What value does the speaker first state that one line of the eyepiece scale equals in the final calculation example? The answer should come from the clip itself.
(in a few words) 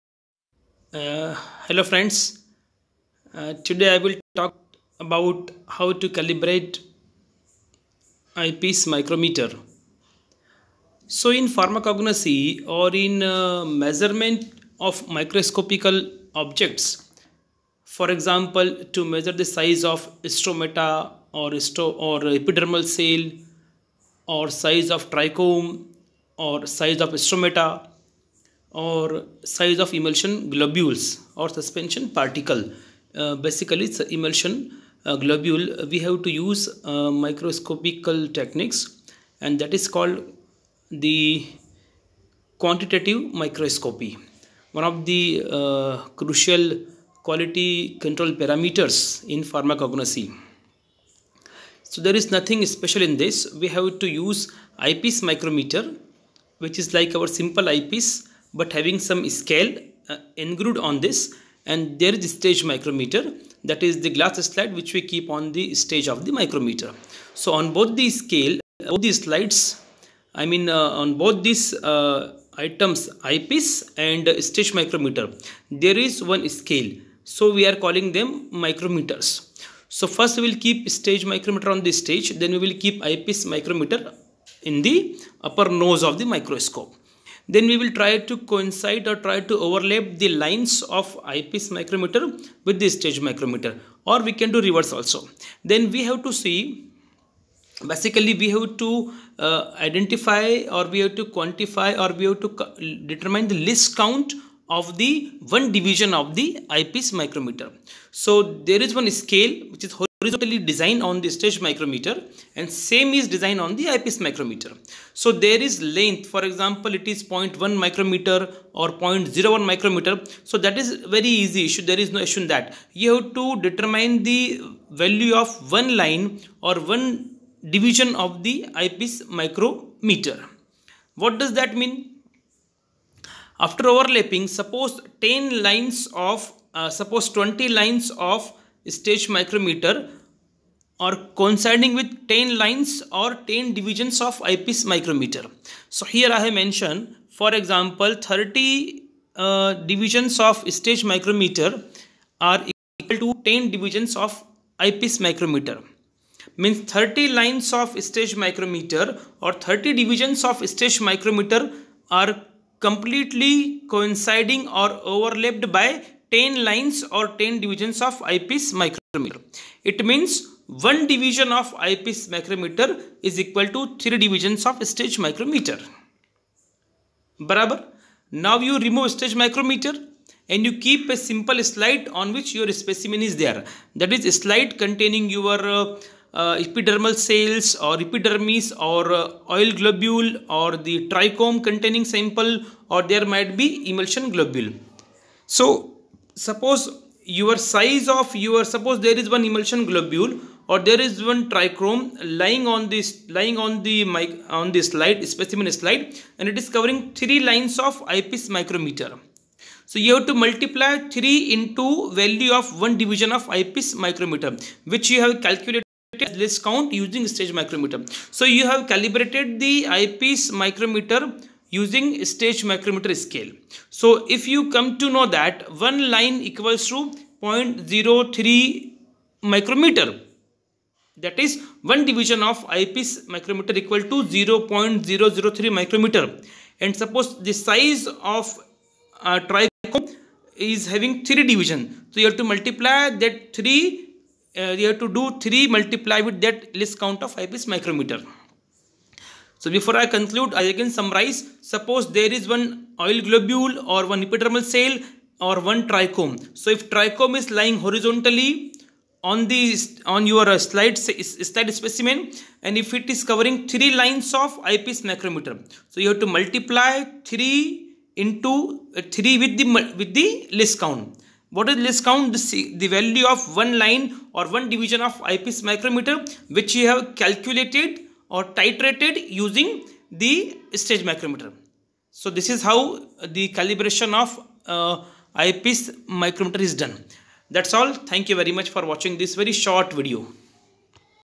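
0.03 micrometer.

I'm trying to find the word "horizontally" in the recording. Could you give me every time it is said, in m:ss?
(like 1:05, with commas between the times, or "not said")
1:50, 4:17.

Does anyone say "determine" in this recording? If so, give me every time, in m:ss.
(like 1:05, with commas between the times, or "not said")
1:43, 2:03.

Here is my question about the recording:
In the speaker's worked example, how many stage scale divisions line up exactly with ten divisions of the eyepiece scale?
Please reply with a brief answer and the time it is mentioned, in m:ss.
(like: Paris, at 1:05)
30, at 2:28.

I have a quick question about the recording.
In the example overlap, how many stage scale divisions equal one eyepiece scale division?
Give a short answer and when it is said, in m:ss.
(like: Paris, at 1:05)
3, at 2:53.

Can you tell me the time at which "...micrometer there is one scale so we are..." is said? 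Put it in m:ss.
1:14.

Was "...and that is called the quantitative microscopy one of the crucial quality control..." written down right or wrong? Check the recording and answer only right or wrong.
right.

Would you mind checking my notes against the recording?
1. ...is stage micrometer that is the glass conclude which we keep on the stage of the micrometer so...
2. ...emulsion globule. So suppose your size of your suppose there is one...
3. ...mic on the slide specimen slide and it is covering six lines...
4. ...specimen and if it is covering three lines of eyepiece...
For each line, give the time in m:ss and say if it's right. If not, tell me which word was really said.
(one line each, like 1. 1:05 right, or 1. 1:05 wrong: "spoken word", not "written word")
1. 1:02 wrong: "slide", not "conclude"
2. 3:13 right
3. 3:24 wrong: "three", not "six"
4. 4:21 right.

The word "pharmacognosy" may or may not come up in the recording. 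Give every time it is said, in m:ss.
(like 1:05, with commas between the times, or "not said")
0:11, 0:49.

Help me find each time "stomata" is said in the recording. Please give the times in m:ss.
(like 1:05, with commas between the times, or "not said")
0:20, 0:27.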